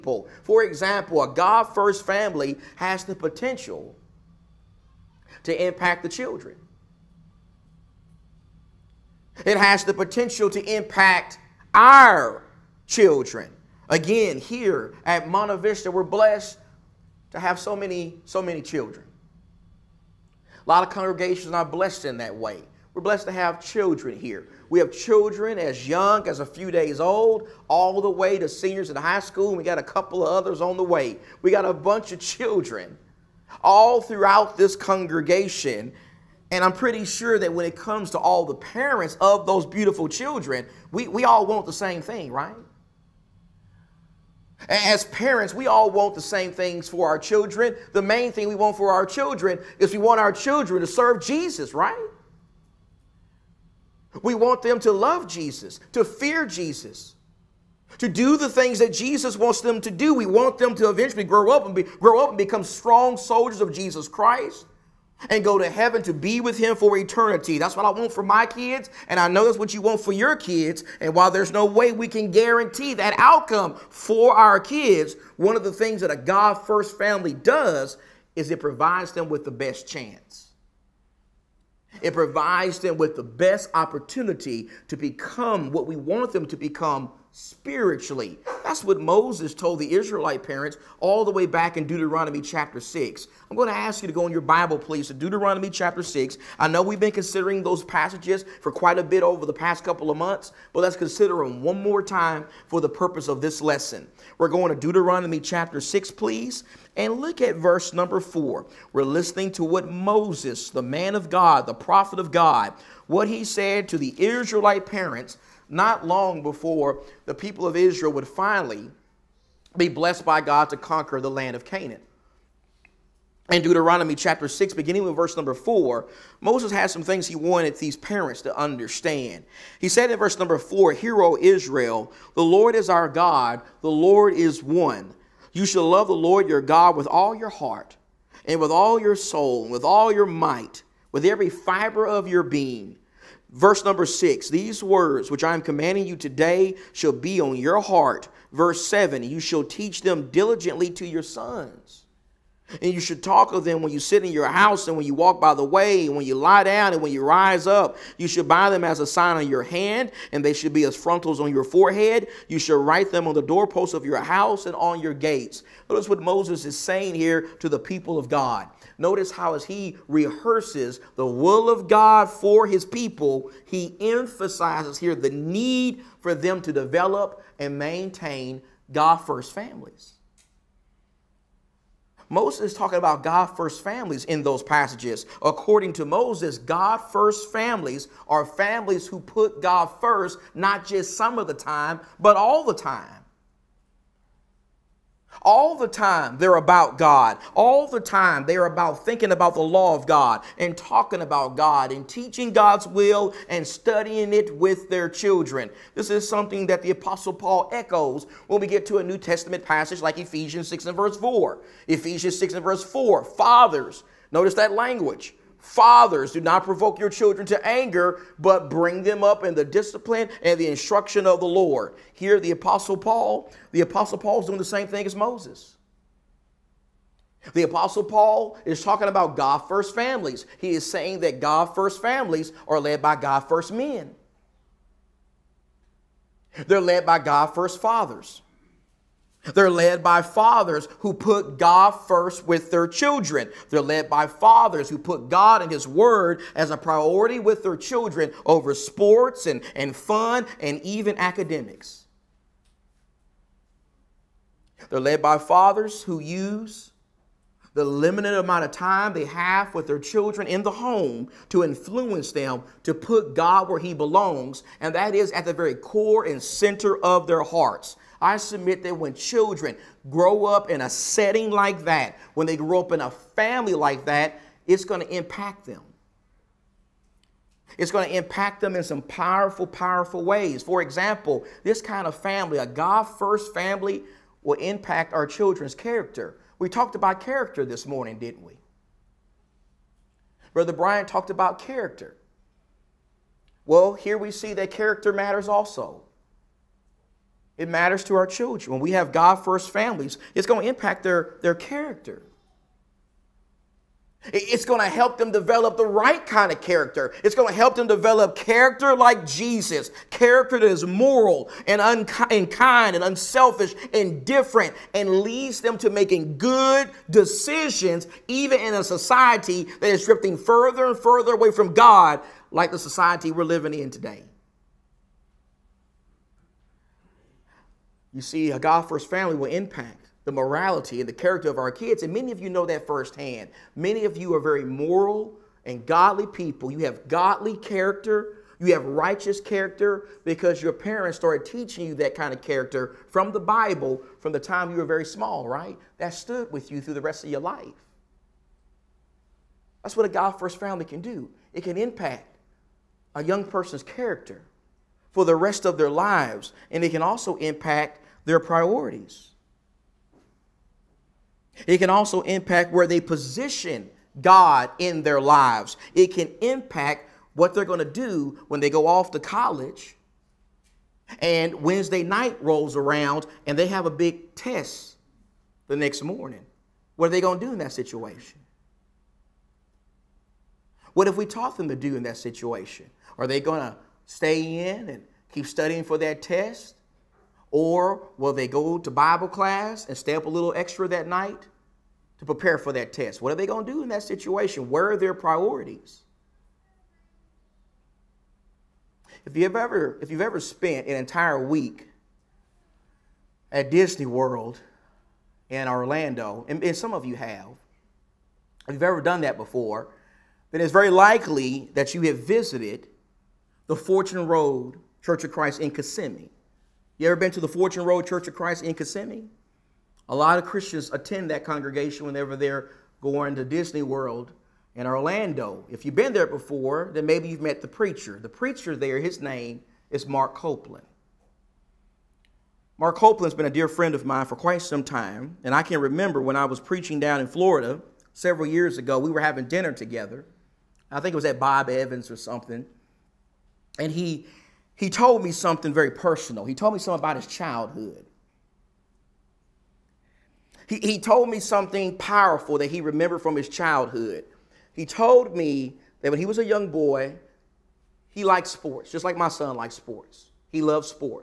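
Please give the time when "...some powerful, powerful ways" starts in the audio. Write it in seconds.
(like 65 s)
278 s.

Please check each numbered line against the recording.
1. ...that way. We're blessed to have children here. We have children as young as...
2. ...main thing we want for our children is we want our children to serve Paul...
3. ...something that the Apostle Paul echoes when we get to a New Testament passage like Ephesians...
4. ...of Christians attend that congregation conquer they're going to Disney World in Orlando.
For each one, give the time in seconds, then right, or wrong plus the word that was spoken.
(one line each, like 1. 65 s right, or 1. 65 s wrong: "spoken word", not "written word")
1. 22 s right
2. 47 s wrong: "Jesus", not "Paul"
3. 206 s right
4. 420 s wrong: "whenever", not "conquer".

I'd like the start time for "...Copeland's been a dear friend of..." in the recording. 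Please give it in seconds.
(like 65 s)
432 s.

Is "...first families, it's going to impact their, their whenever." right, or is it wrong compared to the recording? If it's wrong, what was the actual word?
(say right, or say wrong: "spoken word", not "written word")
wrong: "character", not "whenever".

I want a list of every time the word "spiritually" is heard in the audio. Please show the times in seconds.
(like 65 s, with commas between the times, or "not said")
87 s.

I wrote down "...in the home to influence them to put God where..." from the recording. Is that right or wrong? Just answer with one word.
right.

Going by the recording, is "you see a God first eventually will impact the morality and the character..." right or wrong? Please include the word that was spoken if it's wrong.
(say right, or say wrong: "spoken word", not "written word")
wrong: "family", not "eventually".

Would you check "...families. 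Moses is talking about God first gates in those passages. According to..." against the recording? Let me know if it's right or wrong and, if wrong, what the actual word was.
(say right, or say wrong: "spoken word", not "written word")
wrong: "families", not "gates".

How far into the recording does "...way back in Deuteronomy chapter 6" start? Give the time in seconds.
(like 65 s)
91 s.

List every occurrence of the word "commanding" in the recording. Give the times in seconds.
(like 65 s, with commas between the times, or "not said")
145 s.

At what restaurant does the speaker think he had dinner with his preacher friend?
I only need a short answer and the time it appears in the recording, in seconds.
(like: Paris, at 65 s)
Bob Evans, at 441 s.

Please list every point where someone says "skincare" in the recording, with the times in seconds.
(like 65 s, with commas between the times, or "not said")
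not said.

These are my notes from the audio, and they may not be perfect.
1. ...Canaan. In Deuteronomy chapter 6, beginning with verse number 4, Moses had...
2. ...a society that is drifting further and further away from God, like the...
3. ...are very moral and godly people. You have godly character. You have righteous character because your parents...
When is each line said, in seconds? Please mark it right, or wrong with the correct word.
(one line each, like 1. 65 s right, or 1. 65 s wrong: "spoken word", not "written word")
1. 121 s right
2. 318 s right
3. 334 s right.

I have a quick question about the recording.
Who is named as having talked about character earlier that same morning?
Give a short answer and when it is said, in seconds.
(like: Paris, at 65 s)
Brother Brian, at 290 s.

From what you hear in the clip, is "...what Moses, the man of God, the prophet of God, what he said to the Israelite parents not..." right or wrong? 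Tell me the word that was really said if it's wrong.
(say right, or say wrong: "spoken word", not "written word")
right.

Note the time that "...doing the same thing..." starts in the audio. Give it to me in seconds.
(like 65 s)
224 s.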